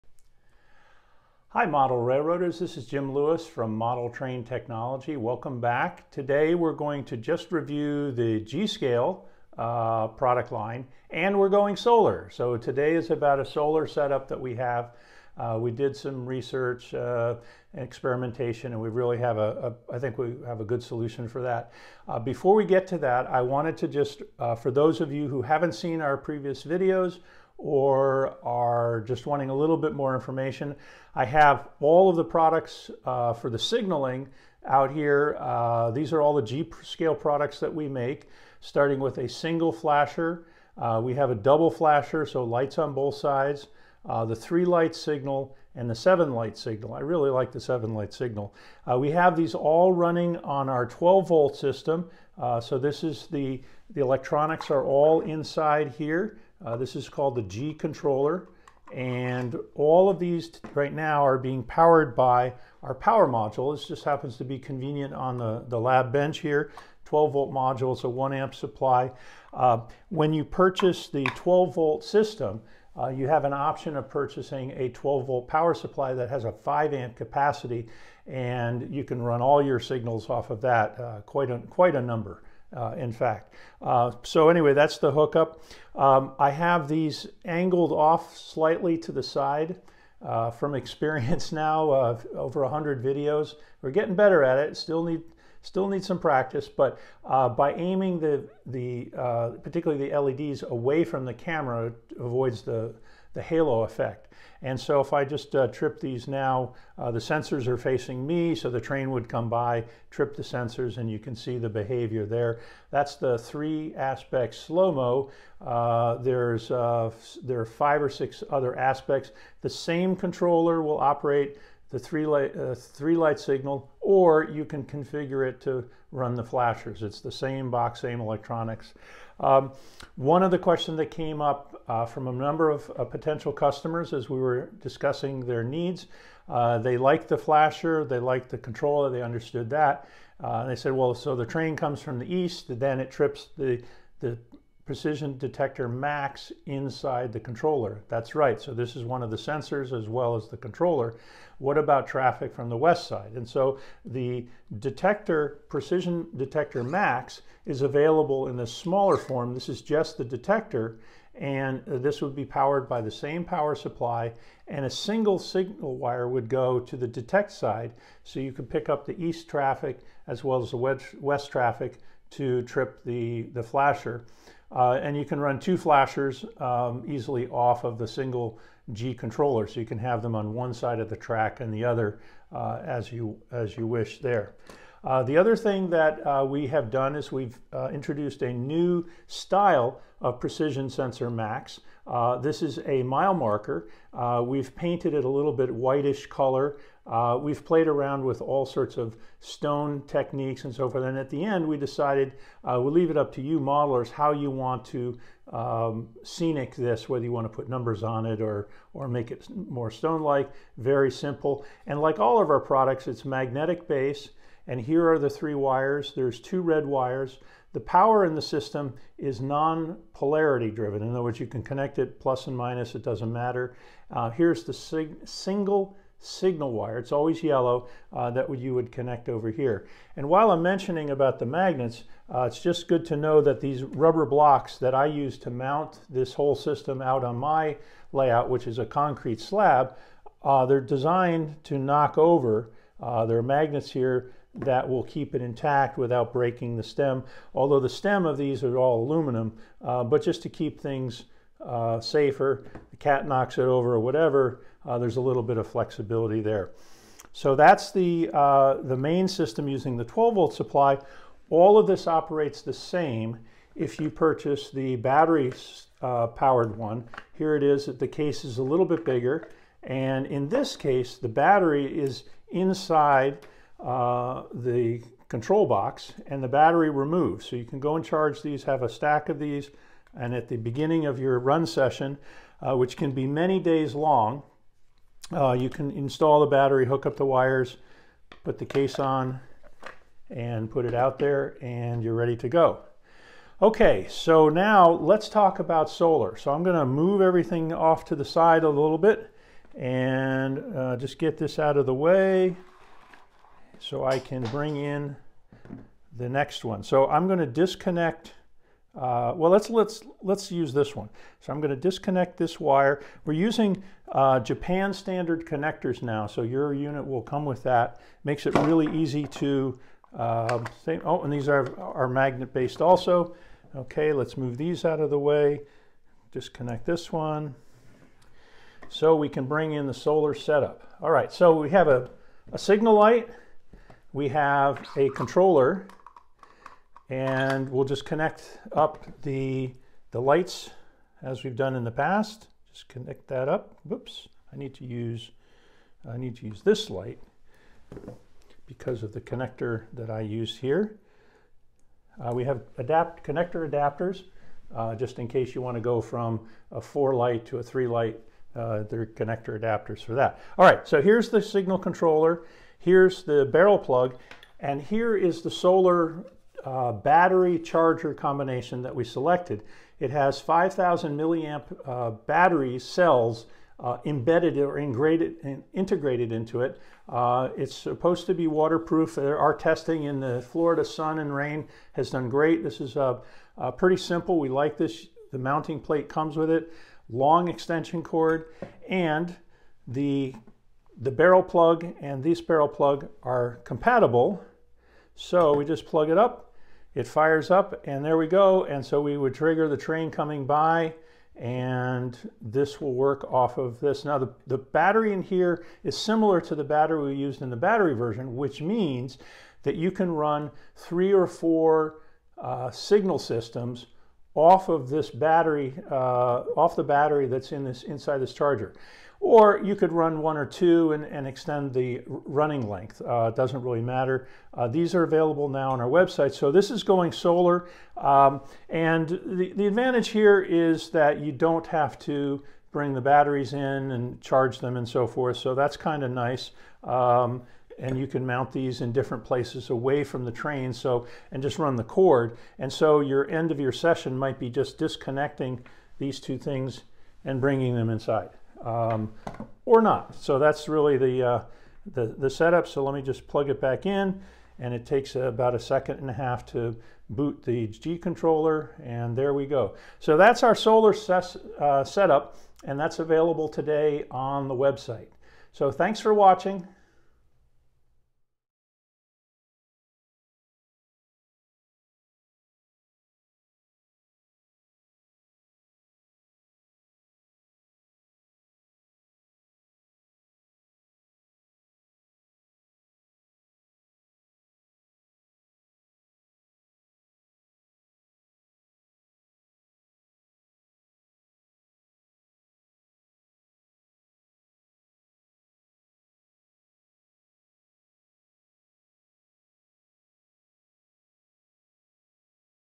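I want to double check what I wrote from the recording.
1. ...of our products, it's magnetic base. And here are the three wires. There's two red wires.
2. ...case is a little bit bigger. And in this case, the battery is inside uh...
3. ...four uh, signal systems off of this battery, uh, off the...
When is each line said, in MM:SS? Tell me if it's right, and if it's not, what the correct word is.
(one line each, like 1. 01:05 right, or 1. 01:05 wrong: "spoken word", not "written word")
1. 03:32 right
2. 04:28 right
3. 06:51 right.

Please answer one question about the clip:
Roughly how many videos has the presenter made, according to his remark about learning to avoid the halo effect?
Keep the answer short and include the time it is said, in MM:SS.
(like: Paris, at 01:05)
over 100, at 01:32.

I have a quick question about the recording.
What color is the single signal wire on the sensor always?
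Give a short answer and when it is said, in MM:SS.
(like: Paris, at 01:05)
Yellow, at 03:47.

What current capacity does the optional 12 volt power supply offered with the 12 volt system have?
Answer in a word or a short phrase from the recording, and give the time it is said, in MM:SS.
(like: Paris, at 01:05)
5 amps, at 01:16.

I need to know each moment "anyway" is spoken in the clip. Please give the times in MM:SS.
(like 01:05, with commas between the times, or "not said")
01:24.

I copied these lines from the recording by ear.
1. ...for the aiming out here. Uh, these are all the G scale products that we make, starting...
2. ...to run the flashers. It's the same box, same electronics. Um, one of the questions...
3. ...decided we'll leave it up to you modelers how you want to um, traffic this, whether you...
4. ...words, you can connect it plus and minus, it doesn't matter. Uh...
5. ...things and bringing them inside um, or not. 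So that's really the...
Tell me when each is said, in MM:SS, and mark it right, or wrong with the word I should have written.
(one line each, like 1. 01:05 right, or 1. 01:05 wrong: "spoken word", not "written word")
1. 00:33 wrong: "signaling", not "aiming"
2. 02:05 right
3. 03:21 wrong: "scenic", not "traffic"
4. 03:41 right
5. 07:26 right.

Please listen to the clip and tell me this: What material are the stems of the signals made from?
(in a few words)
Aluminum.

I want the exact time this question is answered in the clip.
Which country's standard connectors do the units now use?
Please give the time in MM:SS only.
05:14.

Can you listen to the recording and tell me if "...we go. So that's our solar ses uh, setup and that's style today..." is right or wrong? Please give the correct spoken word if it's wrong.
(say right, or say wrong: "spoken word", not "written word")
wrong: "available", not "style".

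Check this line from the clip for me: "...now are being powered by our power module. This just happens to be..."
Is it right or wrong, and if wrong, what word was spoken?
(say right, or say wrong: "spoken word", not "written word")
right.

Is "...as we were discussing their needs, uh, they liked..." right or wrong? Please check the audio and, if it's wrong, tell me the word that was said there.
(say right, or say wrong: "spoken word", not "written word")
right.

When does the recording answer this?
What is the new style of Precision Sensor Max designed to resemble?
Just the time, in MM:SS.
03:13.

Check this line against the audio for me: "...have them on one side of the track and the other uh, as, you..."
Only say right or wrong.
right.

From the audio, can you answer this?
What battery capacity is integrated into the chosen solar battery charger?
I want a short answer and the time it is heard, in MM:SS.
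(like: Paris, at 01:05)
5,000 milliamp, at 06:10.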